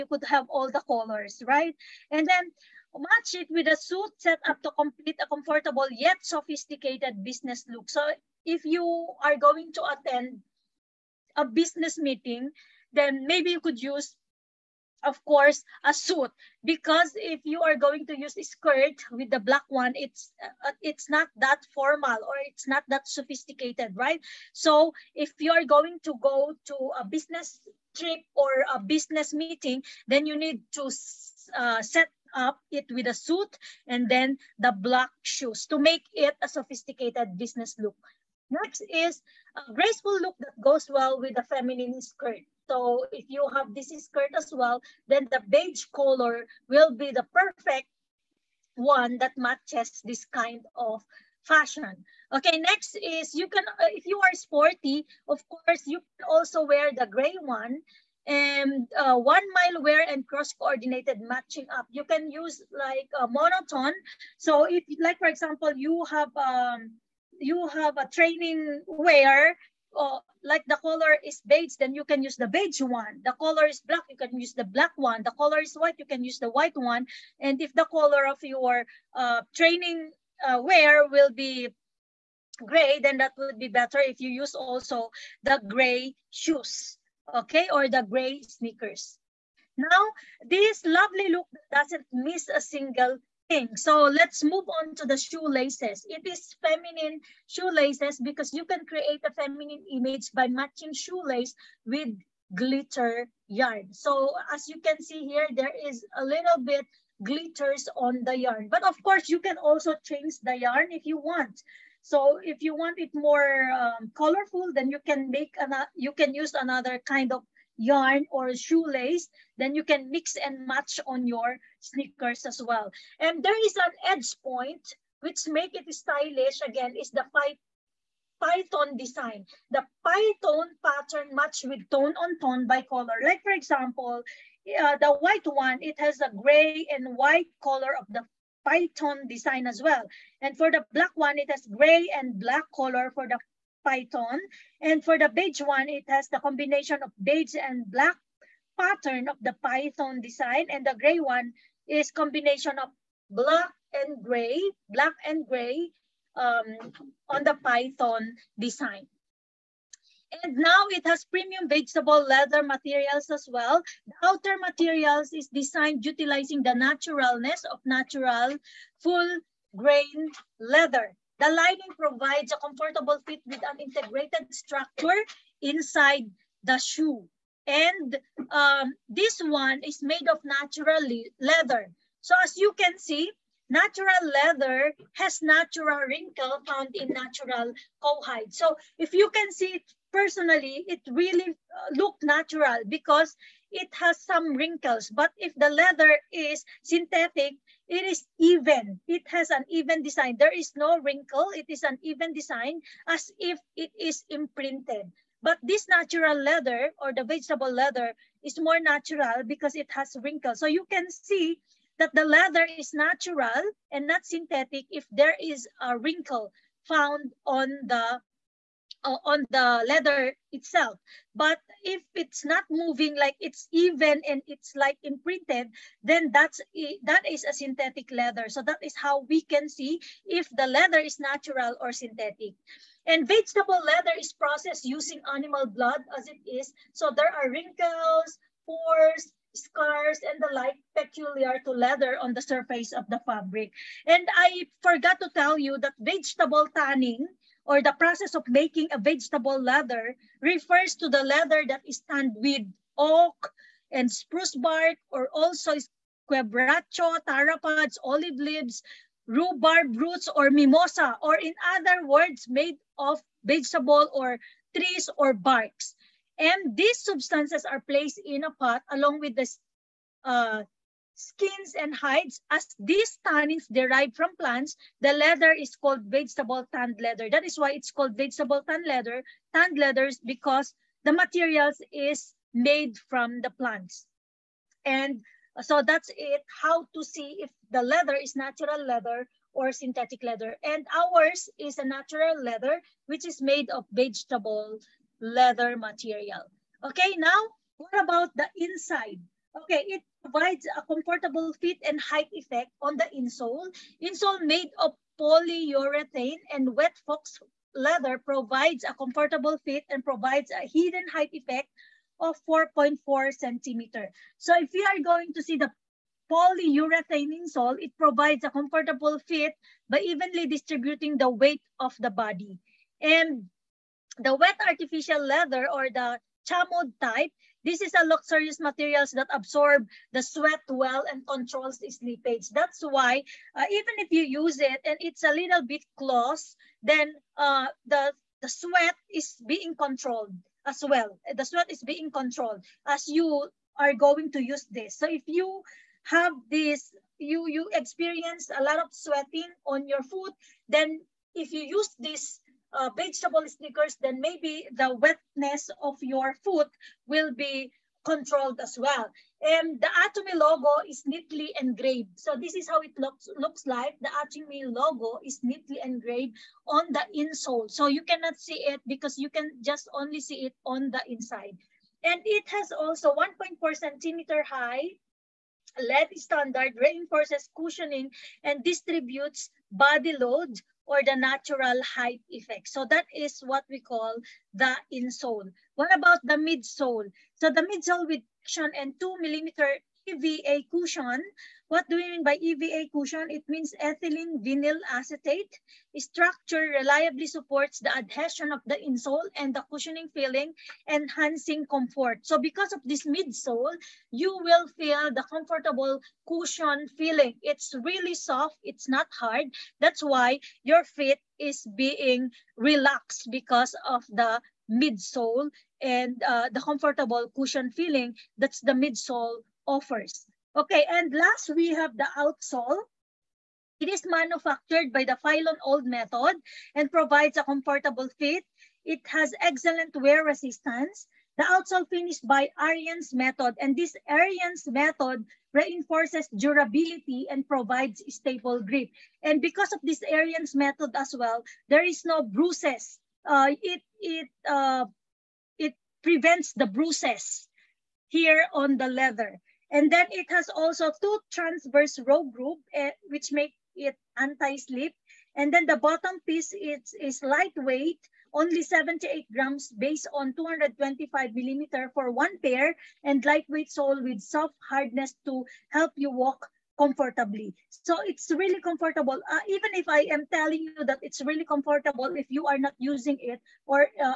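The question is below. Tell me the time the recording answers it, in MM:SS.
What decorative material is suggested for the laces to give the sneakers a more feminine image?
01:42.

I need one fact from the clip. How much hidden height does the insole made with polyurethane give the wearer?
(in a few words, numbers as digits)
4.4 centimeters.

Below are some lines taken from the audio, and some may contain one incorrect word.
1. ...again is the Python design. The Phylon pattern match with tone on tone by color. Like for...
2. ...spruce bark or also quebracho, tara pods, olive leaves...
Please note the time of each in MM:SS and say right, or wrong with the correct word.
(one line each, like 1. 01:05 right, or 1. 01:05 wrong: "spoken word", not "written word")
1. 02:06 wrong: "Python", not "Phylon"
2. 04:14 right.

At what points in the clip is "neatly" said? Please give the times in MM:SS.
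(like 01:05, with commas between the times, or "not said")
06:01, 06:05.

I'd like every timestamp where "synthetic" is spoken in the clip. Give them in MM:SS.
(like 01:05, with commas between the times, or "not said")
03:16, 03:34, 03:47, 03:51, 04:49.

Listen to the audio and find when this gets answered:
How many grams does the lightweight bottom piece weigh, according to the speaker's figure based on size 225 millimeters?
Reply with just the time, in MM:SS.
07:38.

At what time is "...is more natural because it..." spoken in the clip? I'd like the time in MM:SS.
03:28.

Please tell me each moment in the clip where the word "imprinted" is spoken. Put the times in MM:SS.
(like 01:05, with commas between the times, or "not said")
03:24, 03:45.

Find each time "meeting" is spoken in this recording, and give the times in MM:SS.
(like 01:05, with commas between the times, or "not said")
00:11, 00:29.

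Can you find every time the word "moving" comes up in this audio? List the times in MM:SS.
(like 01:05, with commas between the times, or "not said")
03:42.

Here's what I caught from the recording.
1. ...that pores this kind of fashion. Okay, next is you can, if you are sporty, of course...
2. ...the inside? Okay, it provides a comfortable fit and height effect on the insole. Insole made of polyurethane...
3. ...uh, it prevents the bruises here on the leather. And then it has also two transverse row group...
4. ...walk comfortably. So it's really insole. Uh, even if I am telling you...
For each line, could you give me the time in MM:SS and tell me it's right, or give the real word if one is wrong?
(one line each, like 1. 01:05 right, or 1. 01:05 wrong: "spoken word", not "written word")
1. 00:49 wrong: "matches", not "pores"
2. 04:58 right
3. 07:24 right
4. 07:46 wrong: "comfortable", not "insole".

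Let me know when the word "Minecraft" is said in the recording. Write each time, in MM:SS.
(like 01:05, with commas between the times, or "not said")
not said.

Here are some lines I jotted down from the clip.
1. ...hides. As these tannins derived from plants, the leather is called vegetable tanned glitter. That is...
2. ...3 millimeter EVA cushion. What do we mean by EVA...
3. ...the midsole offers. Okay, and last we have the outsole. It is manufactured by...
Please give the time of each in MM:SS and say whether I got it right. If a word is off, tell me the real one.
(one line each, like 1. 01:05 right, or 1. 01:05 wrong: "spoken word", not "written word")
1. 04:31 wrong: "leather", not "glitter"
2. 06:28 wrong: "2", not "3"
3. 06:58 right.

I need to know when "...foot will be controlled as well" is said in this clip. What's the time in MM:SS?
05:56.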